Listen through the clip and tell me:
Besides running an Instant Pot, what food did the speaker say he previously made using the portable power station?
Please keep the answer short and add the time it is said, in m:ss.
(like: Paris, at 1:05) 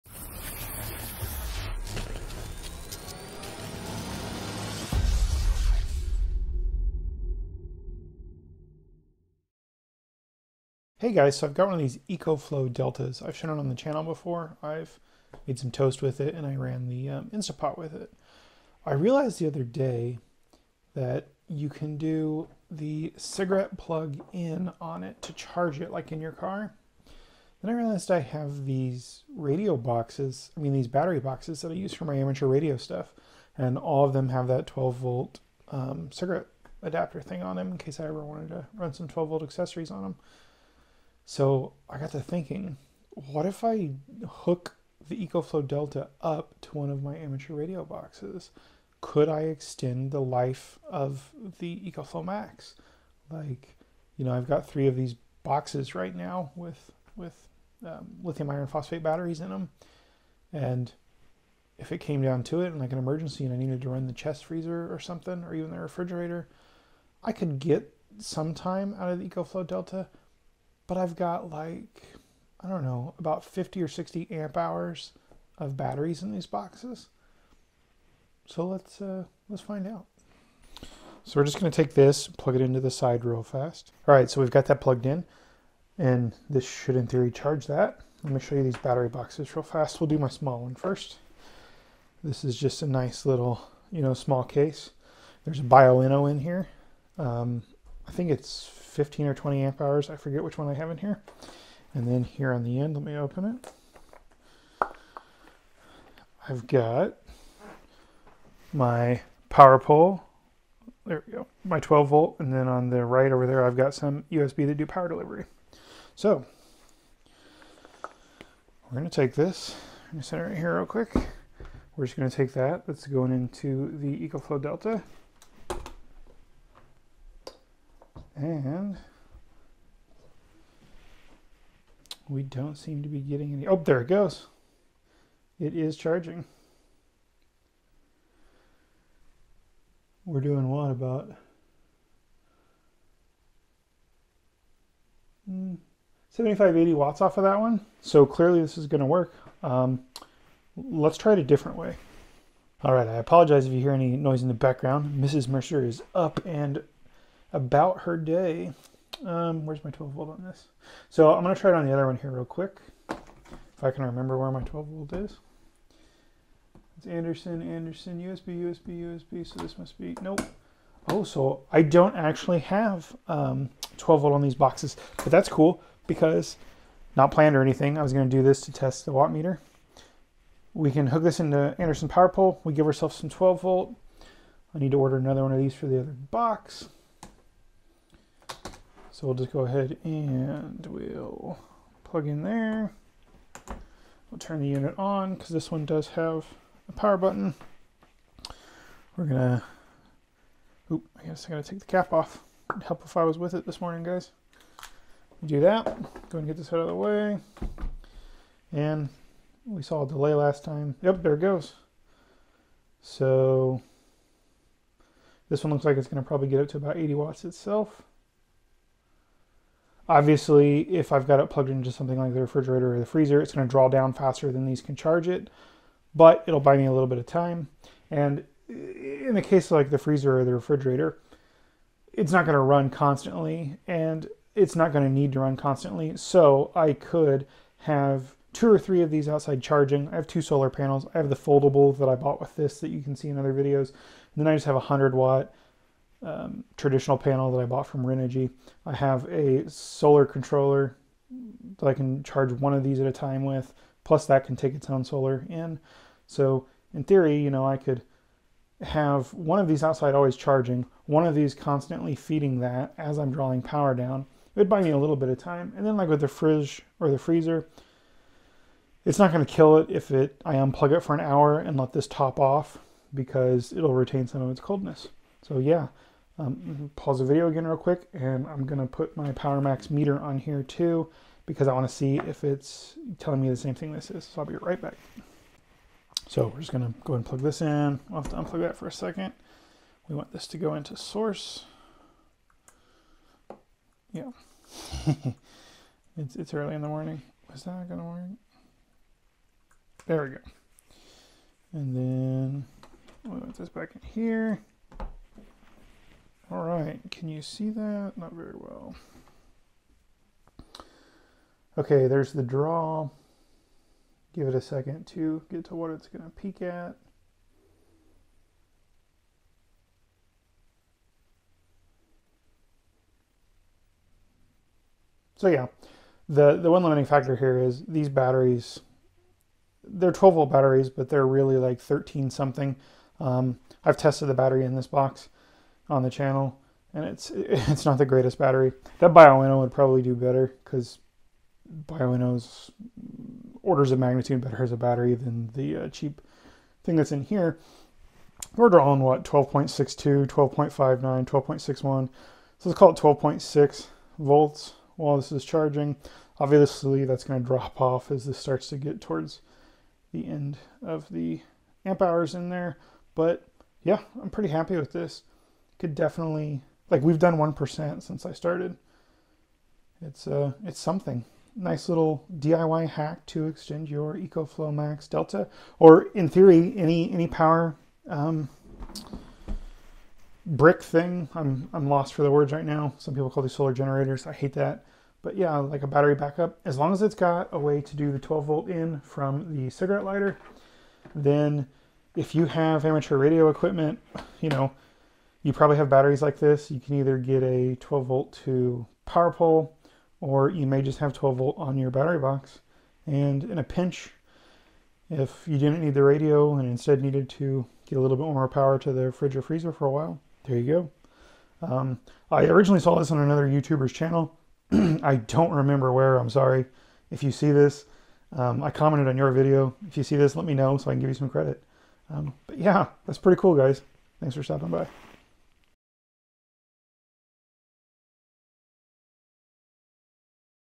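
Toast, at 0:15.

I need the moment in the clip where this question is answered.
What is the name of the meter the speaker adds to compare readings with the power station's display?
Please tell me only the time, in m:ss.
4:39.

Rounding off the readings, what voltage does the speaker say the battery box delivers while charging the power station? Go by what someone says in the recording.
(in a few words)
12.6 volts.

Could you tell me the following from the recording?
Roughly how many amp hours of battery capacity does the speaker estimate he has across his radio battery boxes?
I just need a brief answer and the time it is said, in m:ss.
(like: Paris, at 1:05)
50 or 60, at 1:13.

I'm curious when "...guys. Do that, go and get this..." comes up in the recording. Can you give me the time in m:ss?
3:24.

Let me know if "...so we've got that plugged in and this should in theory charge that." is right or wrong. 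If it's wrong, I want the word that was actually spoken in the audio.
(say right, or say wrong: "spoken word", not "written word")
right.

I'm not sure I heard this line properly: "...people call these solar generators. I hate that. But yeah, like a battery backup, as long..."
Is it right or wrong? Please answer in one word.
right.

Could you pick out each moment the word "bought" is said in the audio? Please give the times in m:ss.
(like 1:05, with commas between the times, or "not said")
4:02, 4:07.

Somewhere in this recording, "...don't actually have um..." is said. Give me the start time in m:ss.
2:51.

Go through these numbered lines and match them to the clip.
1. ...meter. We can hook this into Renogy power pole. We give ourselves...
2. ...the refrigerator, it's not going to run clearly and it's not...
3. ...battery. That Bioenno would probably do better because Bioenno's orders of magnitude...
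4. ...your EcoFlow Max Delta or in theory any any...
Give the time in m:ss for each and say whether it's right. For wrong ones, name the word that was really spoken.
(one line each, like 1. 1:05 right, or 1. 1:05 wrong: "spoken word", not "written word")
1. 2:59 wrong: "Anderson", not "Renogy"
2. 3:50 wrong: "constantly", not "clearly"
3. 5:38 right
4. 6:13 right.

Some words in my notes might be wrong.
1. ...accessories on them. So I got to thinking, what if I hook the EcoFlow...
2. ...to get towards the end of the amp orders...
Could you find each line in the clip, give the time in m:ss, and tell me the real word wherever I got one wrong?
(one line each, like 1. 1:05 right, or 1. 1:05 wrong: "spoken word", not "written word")
1. 0:39 right
2. 5:58 wrong: "hours", not "orders".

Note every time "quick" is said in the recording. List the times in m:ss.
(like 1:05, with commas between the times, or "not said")
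2:00, 2:42, 4:37.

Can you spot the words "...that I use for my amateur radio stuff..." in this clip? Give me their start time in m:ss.
0:31.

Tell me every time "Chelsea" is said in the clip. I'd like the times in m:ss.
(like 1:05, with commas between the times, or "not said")
not said.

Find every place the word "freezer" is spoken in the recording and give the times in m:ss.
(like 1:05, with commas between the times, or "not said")
1:04, 3:43, 3:49, 4:27, 6:49.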